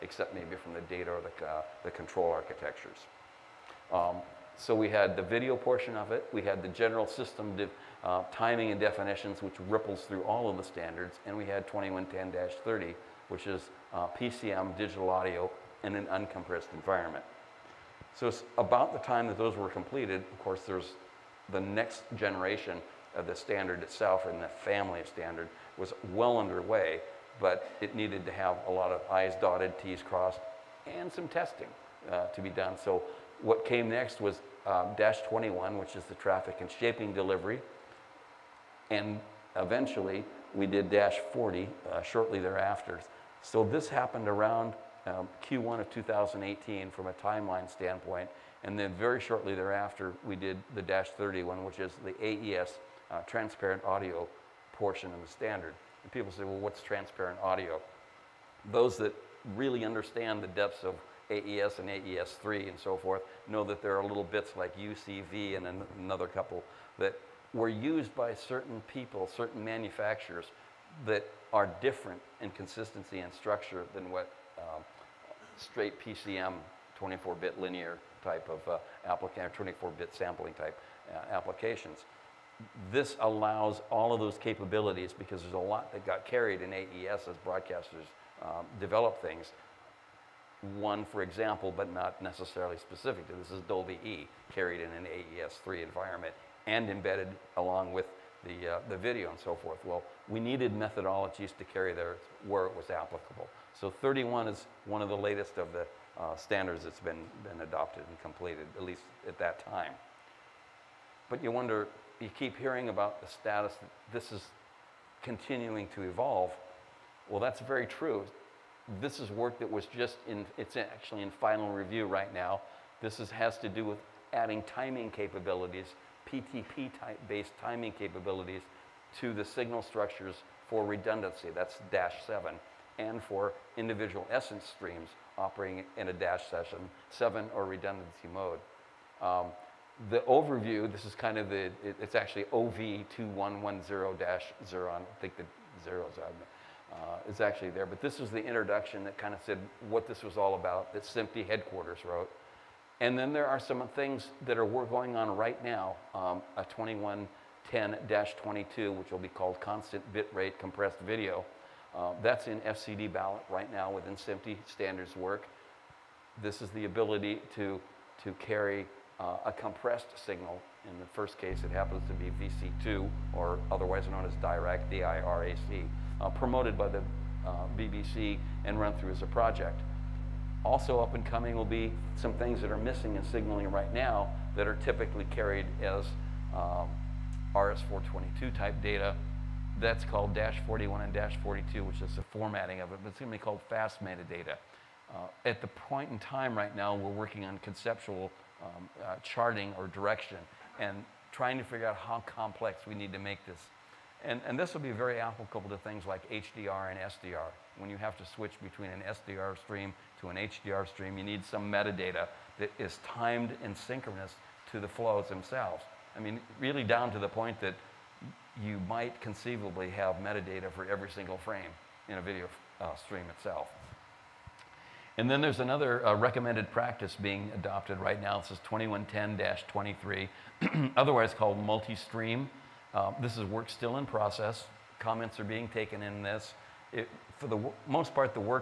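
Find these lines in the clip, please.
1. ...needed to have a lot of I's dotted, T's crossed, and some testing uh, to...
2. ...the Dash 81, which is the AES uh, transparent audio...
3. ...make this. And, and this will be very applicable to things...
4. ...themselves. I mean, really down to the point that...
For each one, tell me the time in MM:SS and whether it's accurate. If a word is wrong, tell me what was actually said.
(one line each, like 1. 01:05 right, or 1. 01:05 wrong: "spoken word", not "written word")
1. 00:27 right
2. 00:50 wrong: "31", not "81"
3. 03:23 right
4. 03:35 right.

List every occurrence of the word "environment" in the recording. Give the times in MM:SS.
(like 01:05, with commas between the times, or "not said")
00:16, 01:35.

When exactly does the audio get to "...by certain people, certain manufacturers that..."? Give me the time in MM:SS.
01:08.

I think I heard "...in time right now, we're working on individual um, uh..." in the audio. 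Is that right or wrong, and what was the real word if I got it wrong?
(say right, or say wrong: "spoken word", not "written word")
wrong: "conceptual", not "individual".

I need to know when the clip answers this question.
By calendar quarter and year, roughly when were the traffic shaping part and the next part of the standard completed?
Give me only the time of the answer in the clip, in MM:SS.
00:45.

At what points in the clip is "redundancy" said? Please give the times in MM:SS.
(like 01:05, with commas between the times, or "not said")
02:10, 02:17.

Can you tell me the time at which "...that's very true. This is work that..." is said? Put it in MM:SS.
01:57.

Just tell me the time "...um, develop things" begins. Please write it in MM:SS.
01:28.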